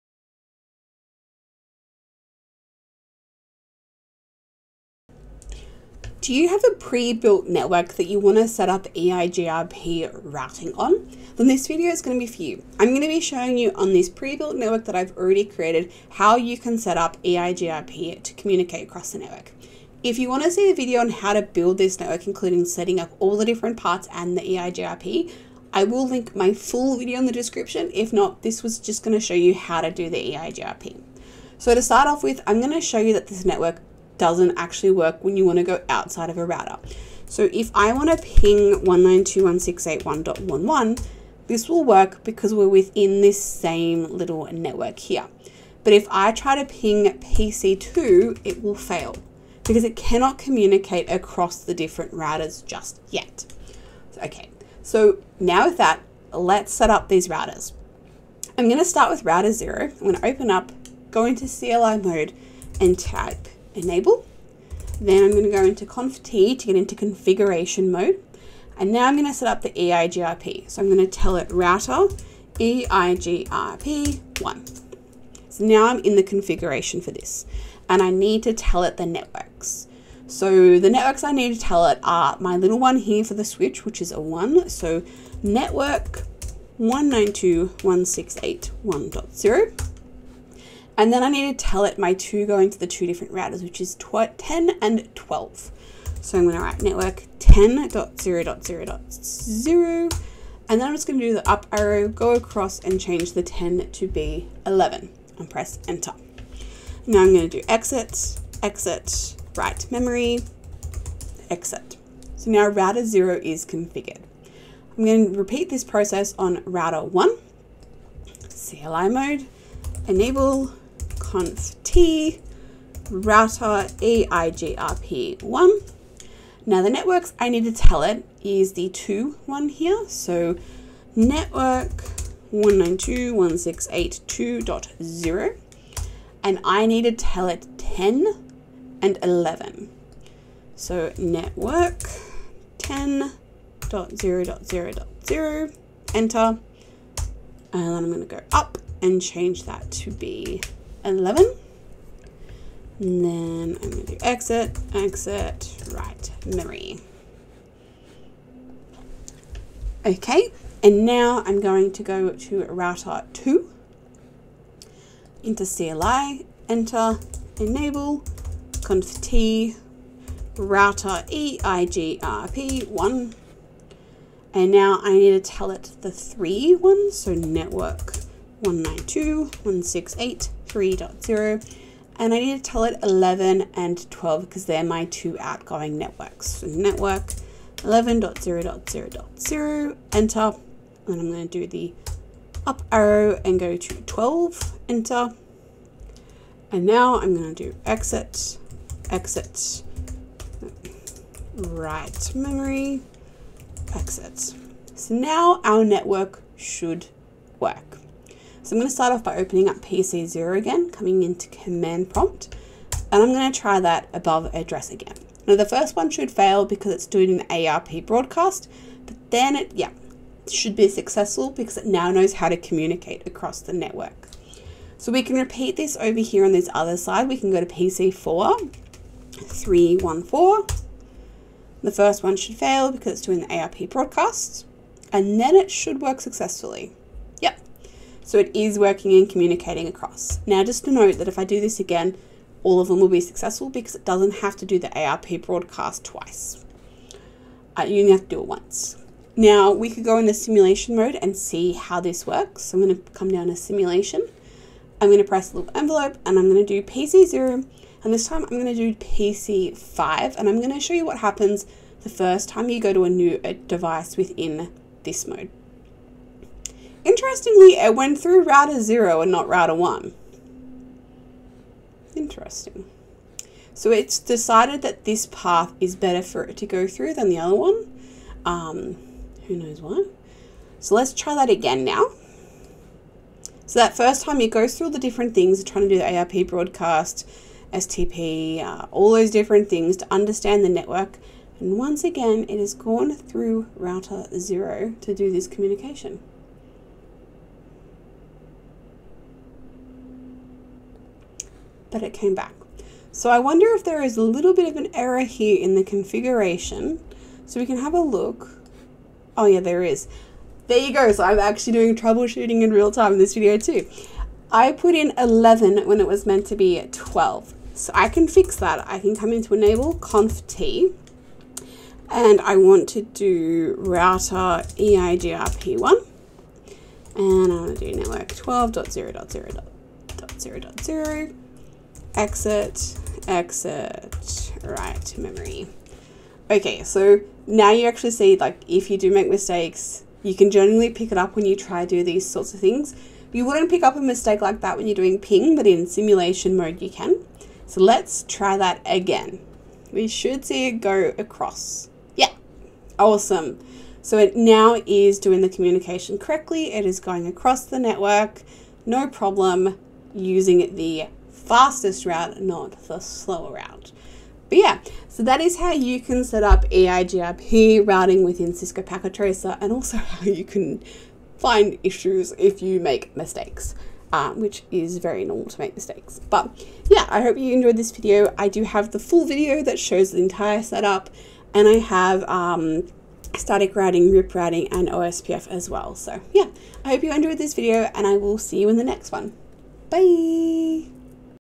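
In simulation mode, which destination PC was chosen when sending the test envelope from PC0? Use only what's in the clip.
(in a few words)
PC5.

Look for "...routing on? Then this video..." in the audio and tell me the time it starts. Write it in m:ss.
0:10.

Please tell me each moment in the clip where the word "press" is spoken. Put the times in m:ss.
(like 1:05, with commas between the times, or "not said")
1:45, 4:15.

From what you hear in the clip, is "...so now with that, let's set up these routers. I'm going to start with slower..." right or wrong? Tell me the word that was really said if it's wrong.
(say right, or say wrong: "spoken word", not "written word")
wrong: "router", not "slower".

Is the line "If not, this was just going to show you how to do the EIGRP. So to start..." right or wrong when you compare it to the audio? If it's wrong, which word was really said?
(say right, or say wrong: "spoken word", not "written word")
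right.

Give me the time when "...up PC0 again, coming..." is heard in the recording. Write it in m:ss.
3:29.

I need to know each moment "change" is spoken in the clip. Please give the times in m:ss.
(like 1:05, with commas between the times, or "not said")
1:42, 2:29.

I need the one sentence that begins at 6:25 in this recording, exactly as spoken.
So yeah, I hope you enjoyed this video and I will see you in the next one.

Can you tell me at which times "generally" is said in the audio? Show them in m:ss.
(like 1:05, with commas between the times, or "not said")
5:40.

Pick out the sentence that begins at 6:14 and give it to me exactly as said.
Um, which is very normal to make mistakes.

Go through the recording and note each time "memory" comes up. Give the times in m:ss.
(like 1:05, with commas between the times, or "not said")
1:49, 2:36, 3:22, 5:35.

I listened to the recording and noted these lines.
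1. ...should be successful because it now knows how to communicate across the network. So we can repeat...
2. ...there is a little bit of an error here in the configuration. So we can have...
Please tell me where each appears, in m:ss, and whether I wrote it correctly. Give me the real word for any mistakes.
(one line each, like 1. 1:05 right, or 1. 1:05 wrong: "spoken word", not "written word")
1. 3:40 right
2. 5:03 right.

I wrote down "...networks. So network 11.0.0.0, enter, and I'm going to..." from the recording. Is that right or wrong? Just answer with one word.
right.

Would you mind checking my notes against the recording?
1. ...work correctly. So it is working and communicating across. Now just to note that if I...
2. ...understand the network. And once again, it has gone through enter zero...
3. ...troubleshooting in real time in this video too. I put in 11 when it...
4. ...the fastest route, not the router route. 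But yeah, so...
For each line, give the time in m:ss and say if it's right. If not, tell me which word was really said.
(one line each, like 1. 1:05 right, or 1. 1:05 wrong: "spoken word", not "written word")
1. 3:55 wrong: "successfully", not "correctly"
2. 4:50 wrong: "router", not "enter"
3. 5:11 right
4. 6:00 wrong: "slower", not "router".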